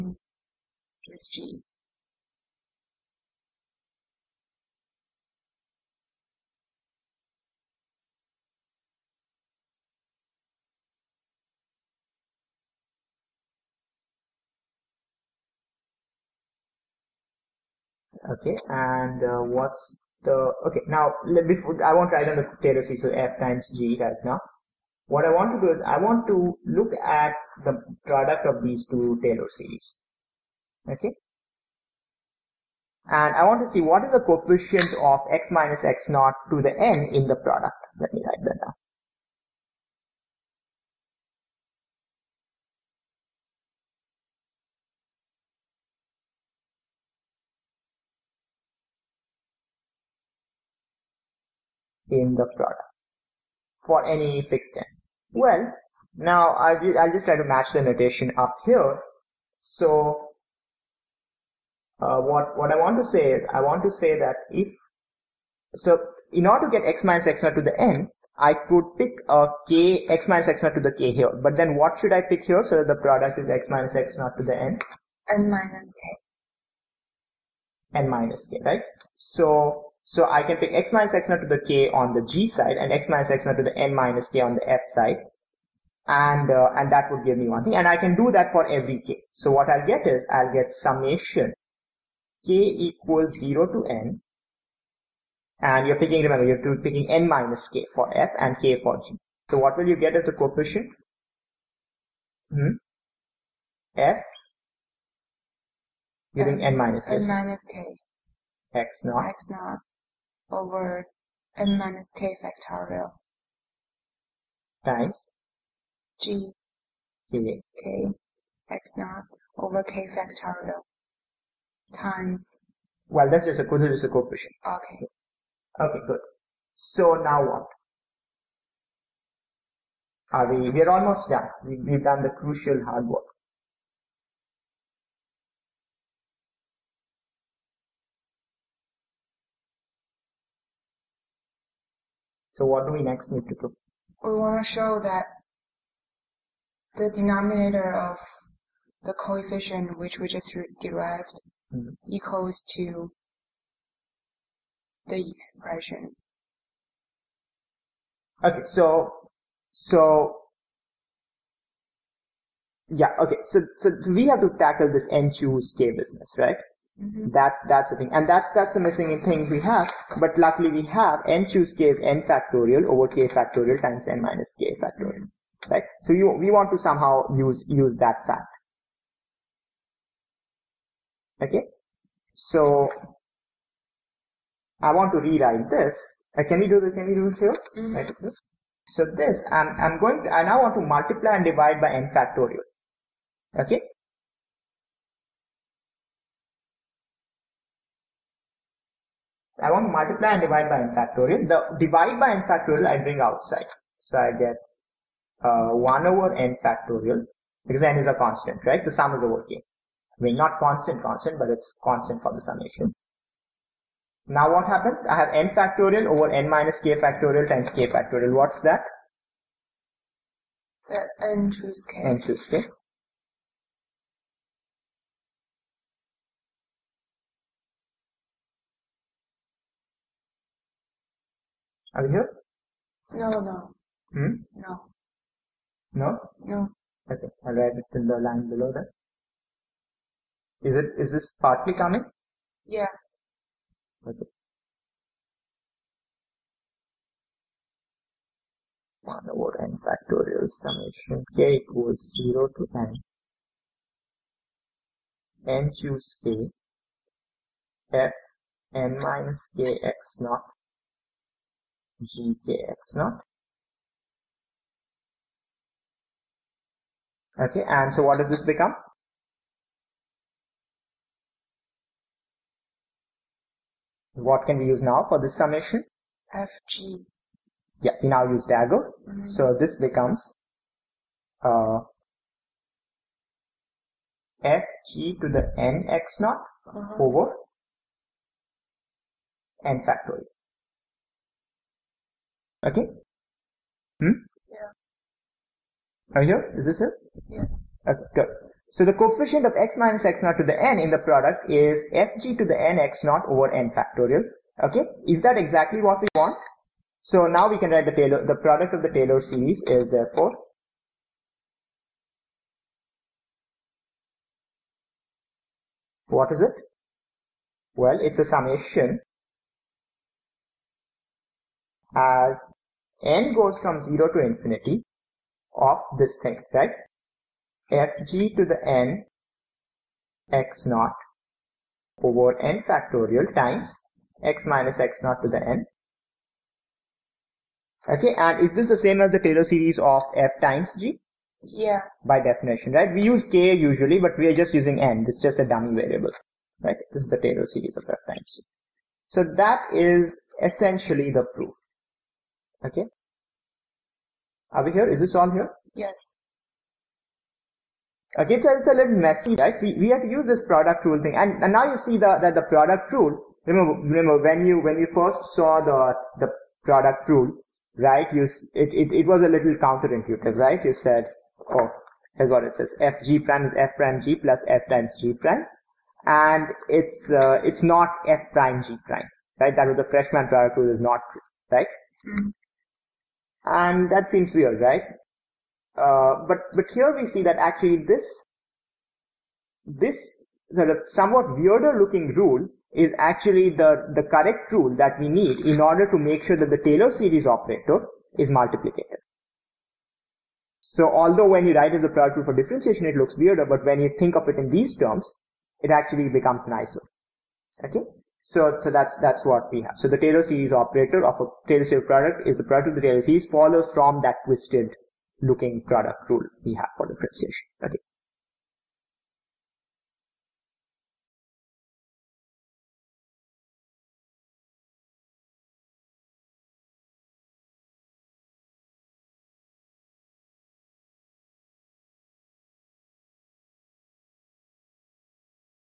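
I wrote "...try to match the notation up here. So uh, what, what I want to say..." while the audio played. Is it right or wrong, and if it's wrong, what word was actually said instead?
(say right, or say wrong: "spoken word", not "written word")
right.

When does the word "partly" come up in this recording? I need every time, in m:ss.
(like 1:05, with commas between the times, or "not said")
4:01.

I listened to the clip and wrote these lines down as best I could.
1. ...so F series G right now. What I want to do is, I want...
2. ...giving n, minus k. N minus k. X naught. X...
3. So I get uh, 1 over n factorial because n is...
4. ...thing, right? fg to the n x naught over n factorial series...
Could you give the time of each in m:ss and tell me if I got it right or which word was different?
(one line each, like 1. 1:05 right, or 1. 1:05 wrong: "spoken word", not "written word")
1. 0:23 wrong: "times", not "series"
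2. 1:46 right
3. 3:24 right
4. 5:26 wrong: "times", not "series".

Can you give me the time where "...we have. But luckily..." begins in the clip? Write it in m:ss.
2:49.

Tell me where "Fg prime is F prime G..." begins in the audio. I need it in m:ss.
6:12.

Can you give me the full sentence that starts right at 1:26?
And, uh, and that would give me one thing.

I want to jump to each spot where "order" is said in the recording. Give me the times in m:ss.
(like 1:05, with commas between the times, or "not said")
1:06, 6:35.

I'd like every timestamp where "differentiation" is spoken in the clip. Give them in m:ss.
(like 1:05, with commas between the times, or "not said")
6:42, 6:56.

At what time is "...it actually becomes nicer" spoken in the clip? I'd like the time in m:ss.
6:45.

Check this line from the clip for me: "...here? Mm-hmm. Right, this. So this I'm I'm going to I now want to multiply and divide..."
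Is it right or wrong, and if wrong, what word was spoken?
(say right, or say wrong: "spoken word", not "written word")
right.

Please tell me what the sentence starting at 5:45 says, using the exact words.
It's just a dummy variable, right?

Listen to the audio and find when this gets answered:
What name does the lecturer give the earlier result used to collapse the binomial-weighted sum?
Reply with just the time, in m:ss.
4:38.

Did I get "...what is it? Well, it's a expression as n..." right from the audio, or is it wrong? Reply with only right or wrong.
wrong.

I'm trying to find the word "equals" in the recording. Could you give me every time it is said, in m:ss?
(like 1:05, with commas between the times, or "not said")
1:32, 2:32, 4:11.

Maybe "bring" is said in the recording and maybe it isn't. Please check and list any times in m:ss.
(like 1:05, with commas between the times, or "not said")
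3:22.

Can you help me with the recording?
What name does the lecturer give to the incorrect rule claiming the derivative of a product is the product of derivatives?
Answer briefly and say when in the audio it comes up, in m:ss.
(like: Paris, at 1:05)
freshman product rule, at 6:19.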